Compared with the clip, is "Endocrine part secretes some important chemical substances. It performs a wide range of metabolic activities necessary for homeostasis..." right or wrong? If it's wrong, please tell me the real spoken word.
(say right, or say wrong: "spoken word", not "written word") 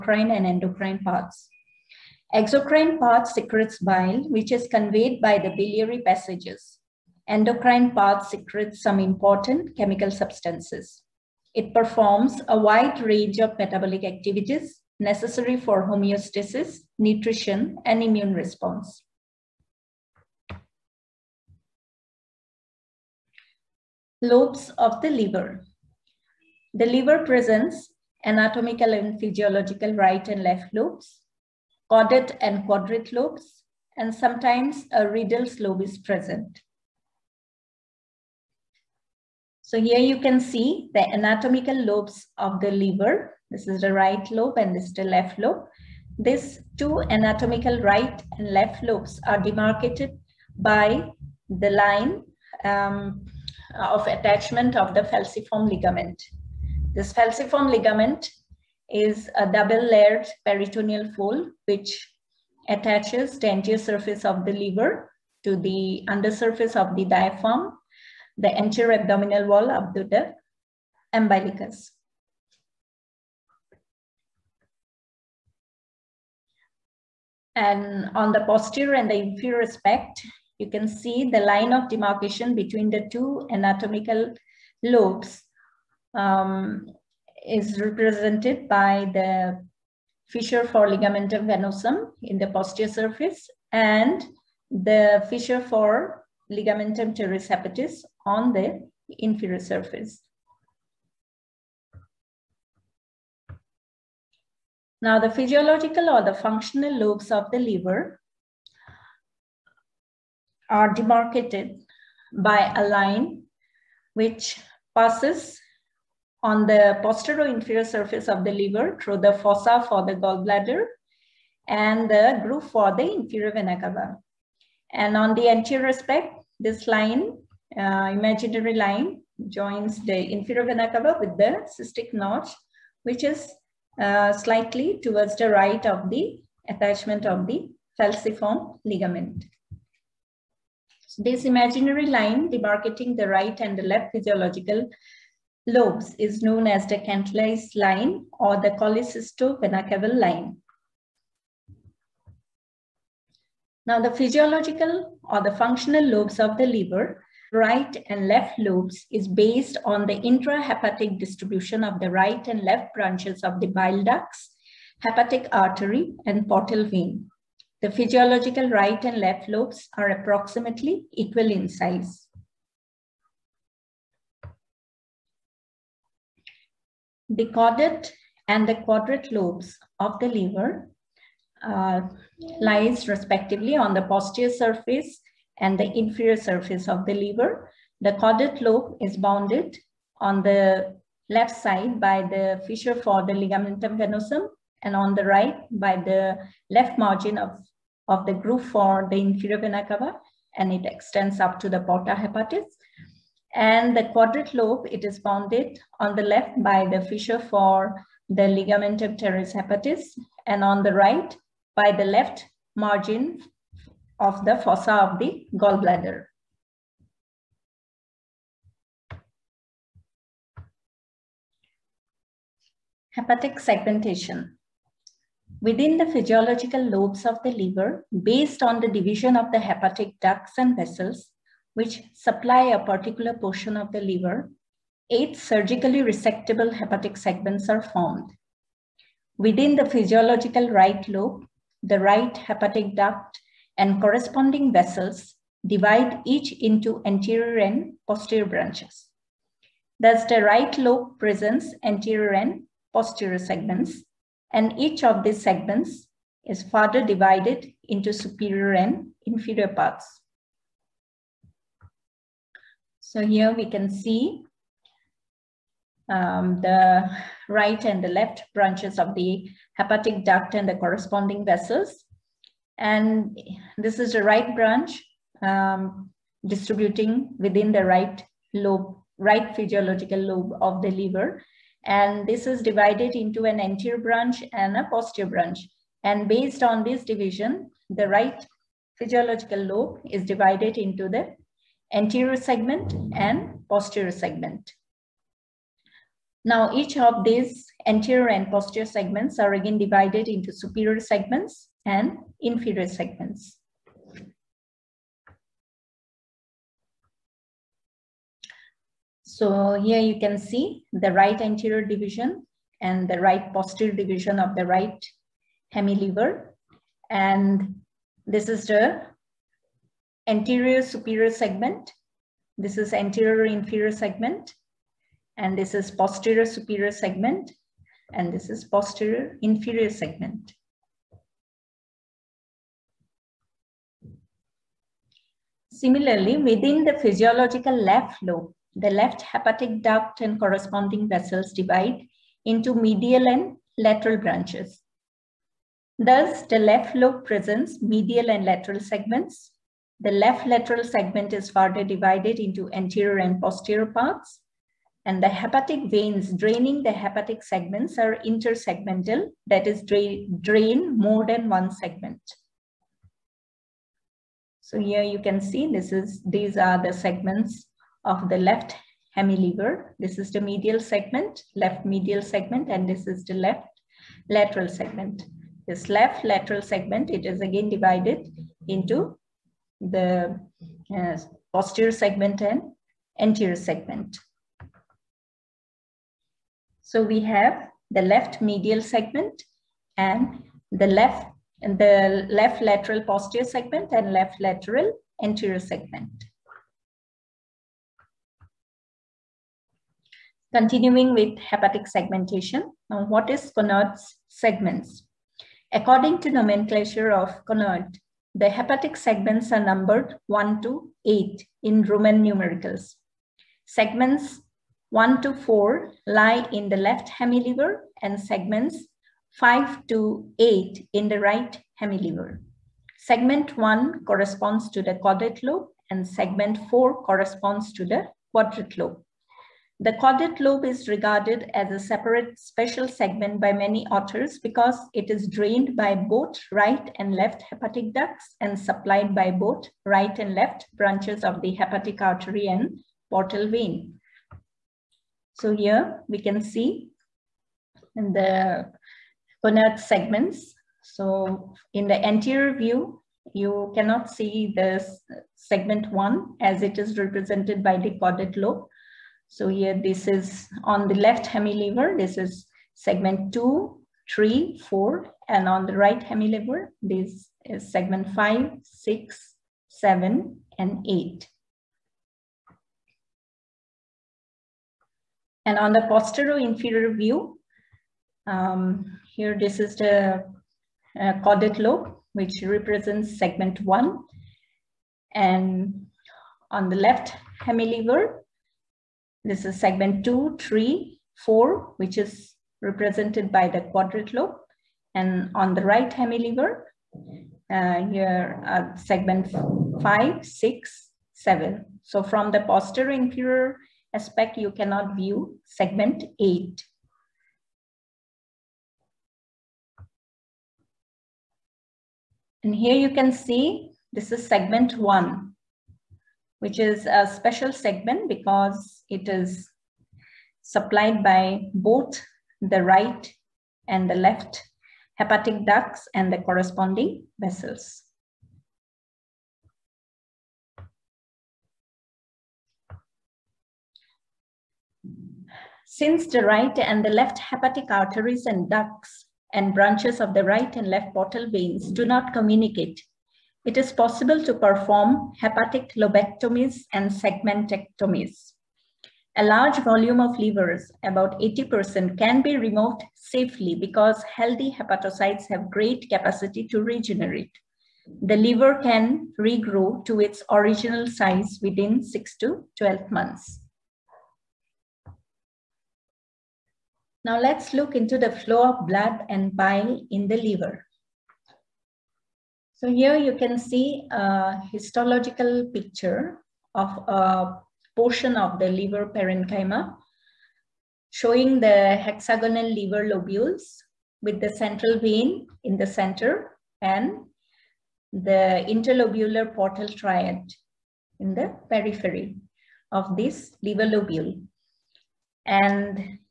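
right.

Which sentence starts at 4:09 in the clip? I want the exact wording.
Thus, the right lobe presents anterior and posterior segments, and each of these segments is further divided into superior and inferior parts.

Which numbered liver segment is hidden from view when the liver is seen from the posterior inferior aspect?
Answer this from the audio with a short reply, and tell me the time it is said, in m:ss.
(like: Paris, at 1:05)
Segment 8, at 8:25.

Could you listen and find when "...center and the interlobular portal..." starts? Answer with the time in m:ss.
9:45.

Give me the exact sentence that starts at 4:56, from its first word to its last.
Now each of these anterior and posterior segments are again divided into superior segments and inferior segments.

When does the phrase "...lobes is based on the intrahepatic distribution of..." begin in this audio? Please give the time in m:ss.
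2:38.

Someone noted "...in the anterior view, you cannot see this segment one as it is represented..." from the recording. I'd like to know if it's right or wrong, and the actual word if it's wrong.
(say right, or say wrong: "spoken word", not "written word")
right.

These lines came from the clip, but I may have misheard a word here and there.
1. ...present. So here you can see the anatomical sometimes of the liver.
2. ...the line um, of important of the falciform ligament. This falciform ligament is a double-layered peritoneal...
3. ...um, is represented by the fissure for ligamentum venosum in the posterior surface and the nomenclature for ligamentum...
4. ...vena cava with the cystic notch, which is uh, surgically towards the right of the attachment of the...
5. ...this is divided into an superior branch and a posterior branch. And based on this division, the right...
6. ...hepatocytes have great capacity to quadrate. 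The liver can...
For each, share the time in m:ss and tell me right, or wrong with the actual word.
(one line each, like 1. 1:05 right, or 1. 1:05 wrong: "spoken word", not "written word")
1. 0:35 wrong: "lobes", not "sometimes"
2. 0:51 wrong: "attachment", not "important"
3. 1:26 wrong: "fissure", not "nomenclature"
4. 2:10 wrong: "slightly", not "surgically"
5. 4:42 wrong: "anterior", not "superior"
6. 9:14 wrong: "regenerate", not "quadrate".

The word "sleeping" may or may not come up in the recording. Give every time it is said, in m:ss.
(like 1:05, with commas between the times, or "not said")
not said.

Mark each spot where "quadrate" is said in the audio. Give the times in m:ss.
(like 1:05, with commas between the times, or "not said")
0:32, 2:58, 3:24, 7:08, 8:13.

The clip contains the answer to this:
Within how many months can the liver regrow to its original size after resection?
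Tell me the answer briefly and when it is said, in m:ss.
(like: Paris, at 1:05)
6 to 12 months, at 9:21.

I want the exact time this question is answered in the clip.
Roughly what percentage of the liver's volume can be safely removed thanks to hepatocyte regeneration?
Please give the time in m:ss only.
9:11.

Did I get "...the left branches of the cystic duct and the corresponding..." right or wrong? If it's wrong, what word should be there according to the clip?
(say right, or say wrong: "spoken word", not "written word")
wrong: "hepatic", not "cystic".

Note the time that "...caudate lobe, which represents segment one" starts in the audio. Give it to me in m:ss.
8:01.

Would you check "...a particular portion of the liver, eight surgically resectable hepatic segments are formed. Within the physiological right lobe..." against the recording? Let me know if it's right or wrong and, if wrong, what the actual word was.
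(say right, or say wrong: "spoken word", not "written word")
right.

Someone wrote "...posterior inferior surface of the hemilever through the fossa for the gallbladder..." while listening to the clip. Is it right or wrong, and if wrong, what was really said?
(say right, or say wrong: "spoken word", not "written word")
wrong: "liver", not "hemilever".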